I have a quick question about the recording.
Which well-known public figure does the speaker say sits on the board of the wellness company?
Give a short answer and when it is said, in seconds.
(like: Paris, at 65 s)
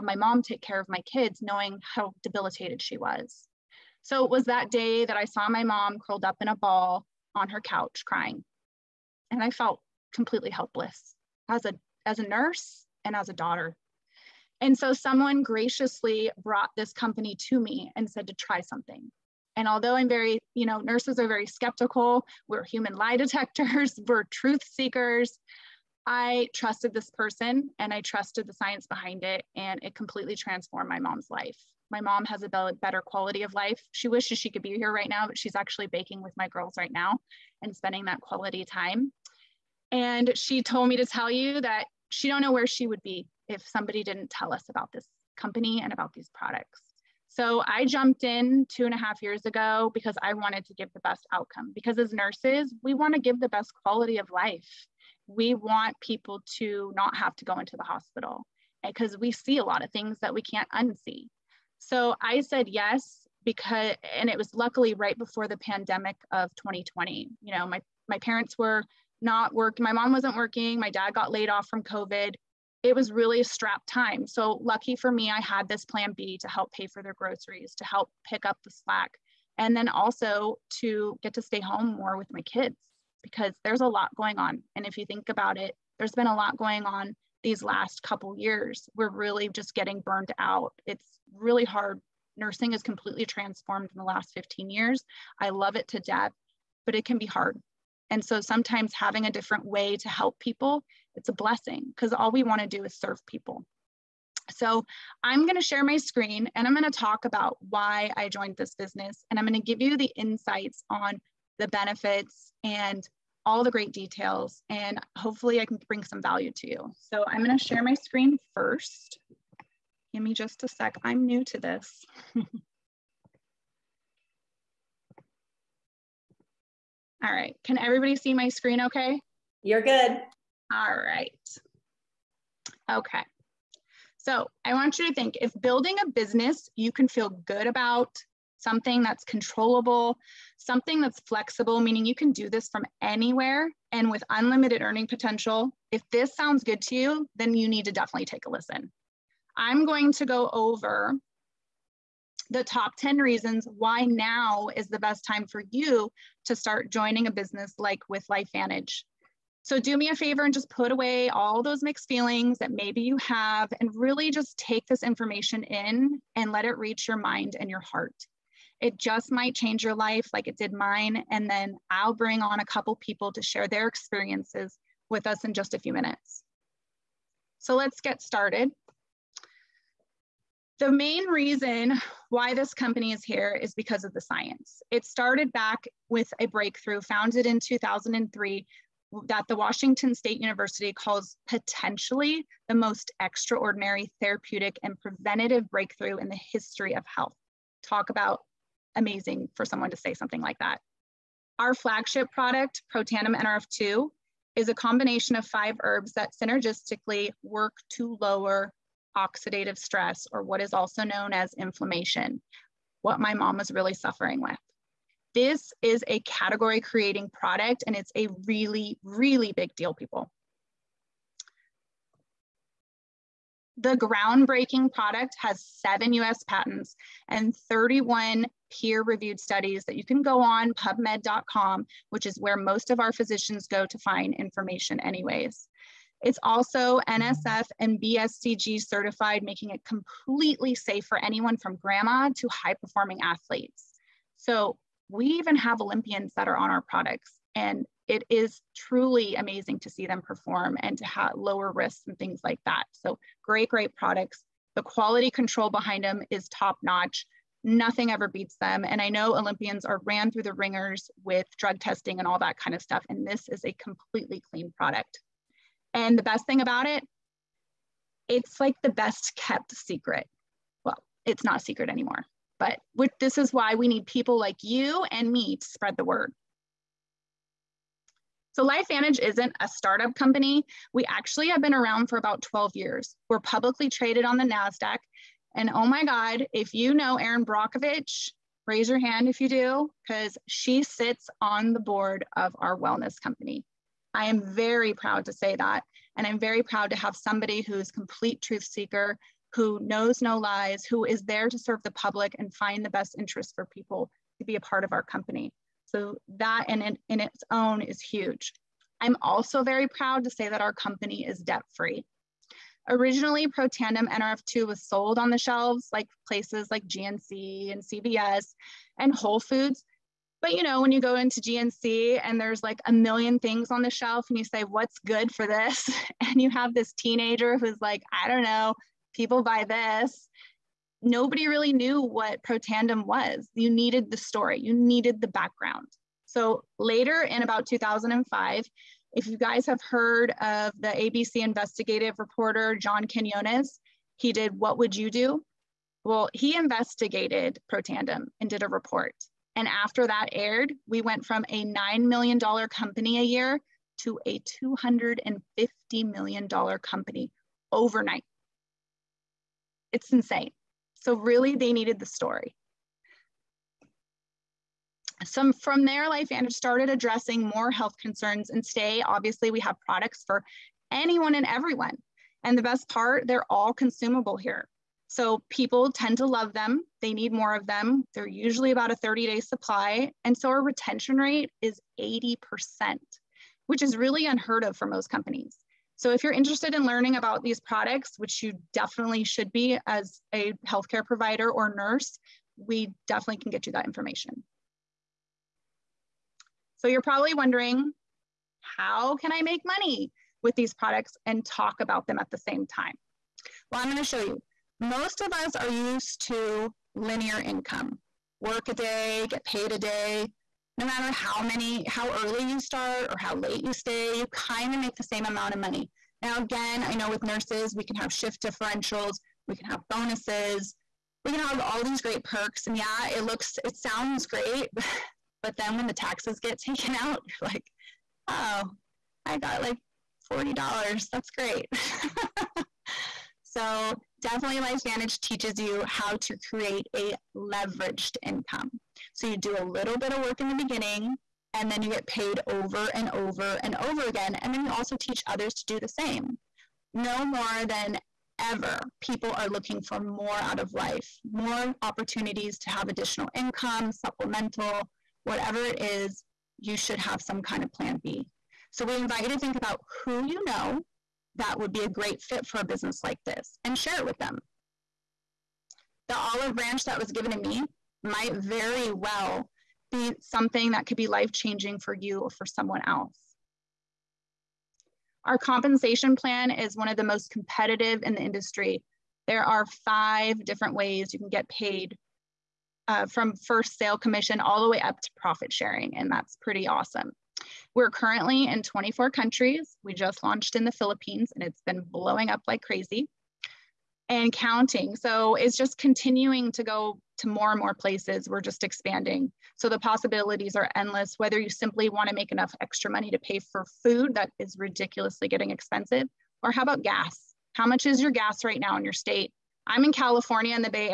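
Erin Brockovich, at 287 s.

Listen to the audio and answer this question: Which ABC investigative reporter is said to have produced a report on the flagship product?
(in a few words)
John Quiñones.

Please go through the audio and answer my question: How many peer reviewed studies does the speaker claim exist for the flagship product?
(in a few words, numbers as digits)
31.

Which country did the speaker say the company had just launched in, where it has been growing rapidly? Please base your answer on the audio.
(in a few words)
Philippines.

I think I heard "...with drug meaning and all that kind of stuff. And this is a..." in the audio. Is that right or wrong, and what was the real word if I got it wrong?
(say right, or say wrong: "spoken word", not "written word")
wrong: "testing", not "meaning".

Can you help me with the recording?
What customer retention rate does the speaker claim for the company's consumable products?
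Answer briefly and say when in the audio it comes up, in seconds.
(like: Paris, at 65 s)
80%, at 381 s.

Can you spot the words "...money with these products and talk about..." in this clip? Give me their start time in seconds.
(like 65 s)
399 s.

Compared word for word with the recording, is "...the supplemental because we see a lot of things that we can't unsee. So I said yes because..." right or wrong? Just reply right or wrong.
wrong.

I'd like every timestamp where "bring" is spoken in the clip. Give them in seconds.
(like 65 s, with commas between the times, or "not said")
115 s, 172 s.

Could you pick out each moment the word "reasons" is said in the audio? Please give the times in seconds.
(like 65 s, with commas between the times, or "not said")
153 s, 181 s.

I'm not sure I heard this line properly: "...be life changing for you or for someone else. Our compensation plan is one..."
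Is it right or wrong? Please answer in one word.
right.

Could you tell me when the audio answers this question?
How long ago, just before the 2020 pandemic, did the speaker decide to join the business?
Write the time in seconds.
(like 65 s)
48 s.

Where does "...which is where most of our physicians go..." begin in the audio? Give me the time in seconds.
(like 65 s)
232 s.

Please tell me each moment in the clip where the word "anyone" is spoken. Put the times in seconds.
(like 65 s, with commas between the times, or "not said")
241 s, 370 s.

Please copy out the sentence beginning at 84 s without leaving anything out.
And if you think about it, there's been a lot going on these last couple years.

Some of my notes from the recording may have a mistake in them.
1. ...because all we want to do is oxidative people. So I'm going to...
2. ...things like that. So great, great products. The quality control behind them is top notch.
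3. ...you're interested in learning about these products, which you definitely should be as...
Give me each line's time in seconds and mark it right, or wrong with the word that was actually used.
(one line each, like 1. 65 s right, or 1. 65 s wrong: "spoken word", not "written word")
1. 101 s wrong: "serve", not "oxidative"
2. 252 s right
3. 386 s right.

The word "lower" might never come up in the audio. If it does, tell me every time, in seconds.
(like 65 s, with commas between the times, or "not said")
208 s, 251 s.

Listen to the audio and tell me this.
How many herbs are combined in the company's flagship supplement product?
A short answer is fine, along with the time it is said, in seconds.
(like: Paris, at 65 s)
5, at 205 s.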